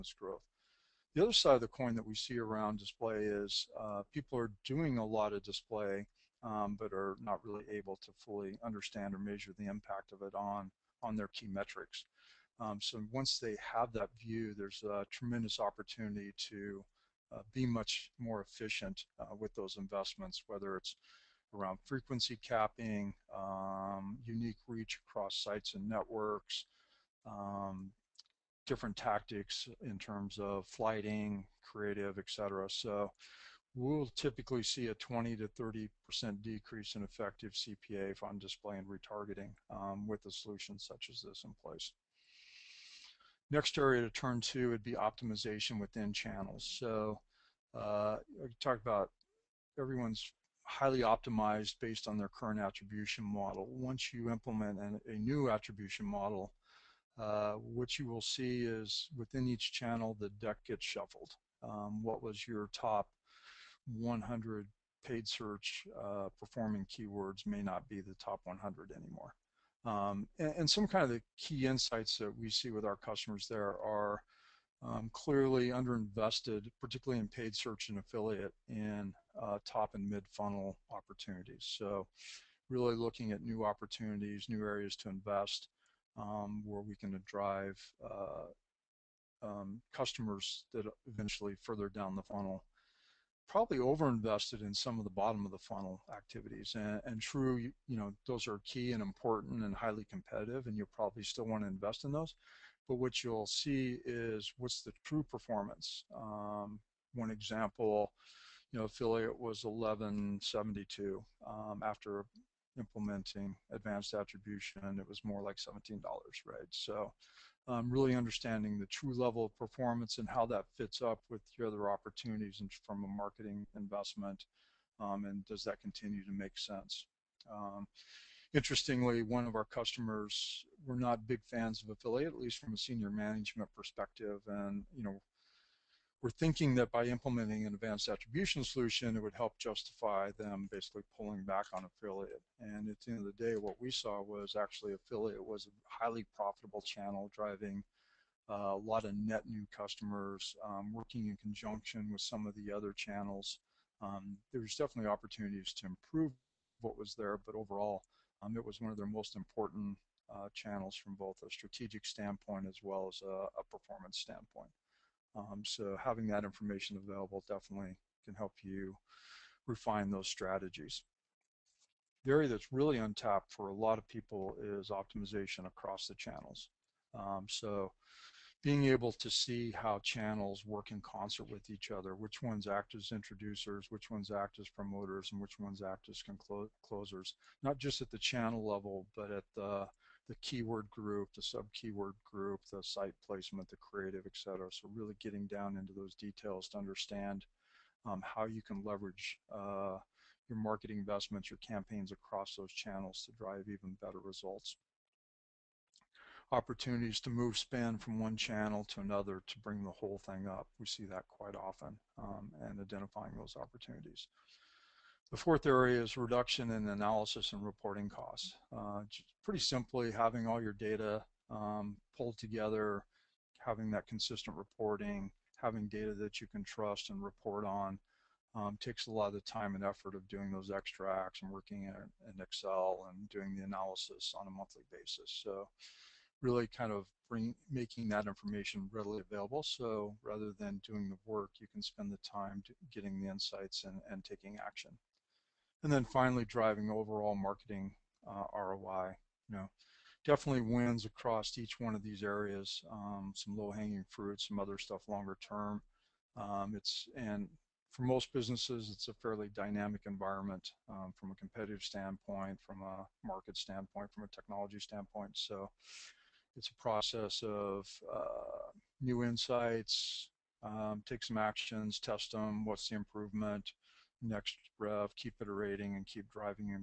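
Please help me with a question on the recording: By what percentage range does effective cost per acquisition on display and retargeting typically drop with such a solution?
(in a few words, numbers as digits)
20 to 30 percent.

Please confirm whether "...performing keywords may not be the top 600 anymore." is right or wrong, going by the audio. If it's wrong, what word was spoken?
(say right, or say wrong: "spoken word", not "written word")
wrong: "100", not "600".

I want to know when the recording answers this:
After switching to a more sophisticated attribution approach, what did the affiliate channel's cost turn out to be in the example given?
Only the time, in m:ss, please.
1:55.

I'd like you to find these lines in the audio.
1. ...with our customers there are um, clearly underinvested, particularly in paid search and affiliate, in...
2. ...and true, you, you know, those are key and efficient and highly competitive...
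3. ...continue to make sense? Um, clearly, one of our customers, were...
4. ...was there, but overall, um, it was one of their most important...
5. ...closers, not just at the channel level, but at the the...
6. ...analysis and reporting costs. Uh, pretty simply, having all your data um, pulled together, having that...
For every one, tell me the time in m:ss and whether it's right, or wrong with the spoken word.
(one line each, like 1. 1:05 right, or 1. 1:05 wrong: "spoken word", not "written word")
1. 1:12 right
2. 1:37 wrong: "important", not "efficient"
3. 2:05 wrong: "interestingly", not "clearly"
4. 2:36 right
5. 3:06 right
6. 3:36 right.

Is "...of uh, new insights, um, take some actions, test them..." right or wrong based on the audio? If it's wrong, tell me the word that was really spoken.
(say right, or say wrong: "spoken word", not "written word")
right.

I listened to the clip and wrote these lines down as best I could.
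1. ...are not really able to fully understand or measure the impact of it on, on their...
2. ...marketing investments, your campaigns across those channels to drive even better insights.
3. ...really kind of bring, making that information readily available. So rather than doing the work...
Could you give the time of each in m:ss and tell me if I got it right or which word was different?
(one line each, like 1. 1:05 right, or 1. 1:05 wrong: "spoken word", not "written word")
1. 0:06 right
2. 3:20 wrong: "results", not "insights"
3. 3:56 right.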